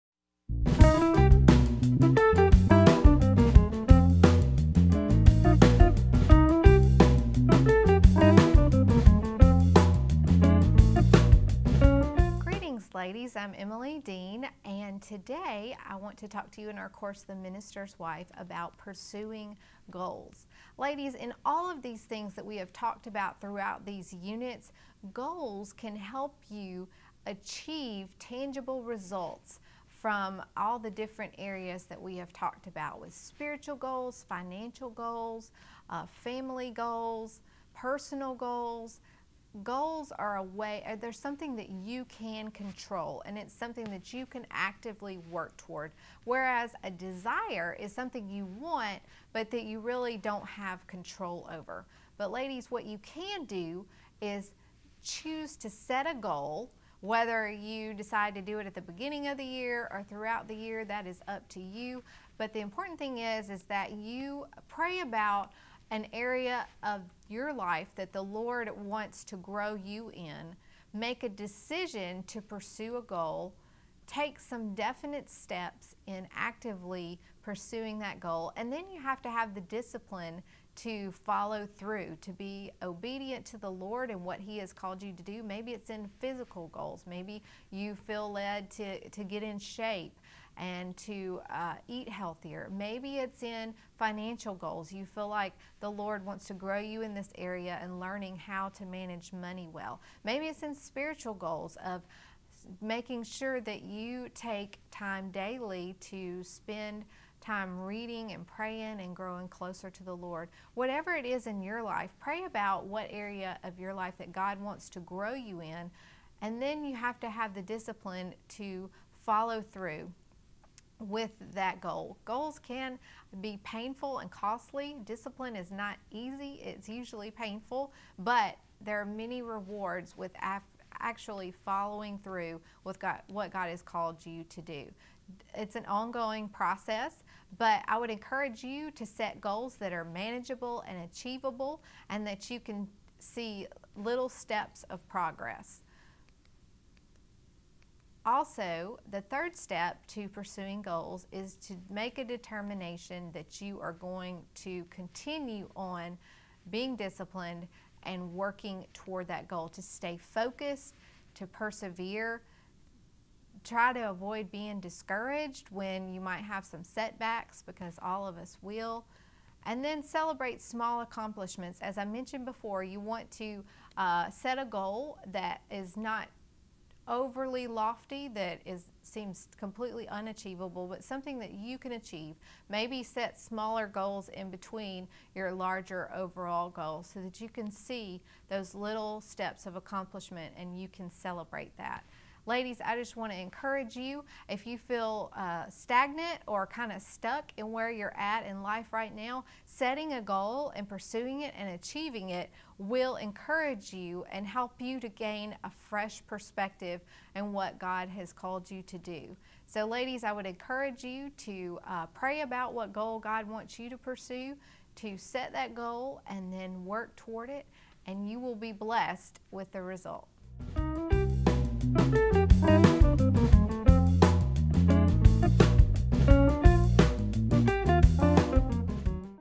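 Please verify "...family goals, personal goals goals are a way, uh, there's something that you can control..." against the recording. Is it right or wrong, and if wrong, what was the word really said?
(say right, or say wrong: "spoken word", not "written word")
right.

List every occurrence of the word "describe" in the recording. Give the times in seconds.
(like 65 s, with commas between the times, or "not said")
not said.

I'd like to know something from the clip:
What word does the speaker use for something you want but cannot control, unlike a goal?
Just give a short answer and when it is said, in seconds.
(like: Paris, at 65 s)
desire, at 46 s.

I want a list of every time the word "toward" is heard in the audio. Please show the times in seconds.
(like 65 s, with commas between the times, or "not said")
45 s, 158 s, 217 s.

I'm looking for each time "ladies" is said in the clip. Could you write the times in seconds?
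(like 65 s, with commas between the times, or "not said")
20 s, 52 s, 192 s, 209 s.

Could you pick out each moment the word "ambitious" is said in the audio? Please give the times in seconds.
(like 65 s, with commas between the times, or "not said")
not said.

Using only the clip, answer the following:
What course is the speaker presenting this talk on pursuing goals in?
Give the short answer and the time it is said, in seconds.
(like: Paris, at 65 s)
The Minister's Wife, at 17 s.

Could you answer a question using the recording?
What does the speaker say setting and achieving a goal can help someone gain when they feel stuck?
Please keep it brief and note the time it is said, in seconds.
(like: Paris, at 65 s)
a fresh perspective, at 205 s.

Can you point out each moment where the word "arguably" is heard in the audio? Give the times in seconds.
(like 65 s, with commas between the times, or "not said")
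not said.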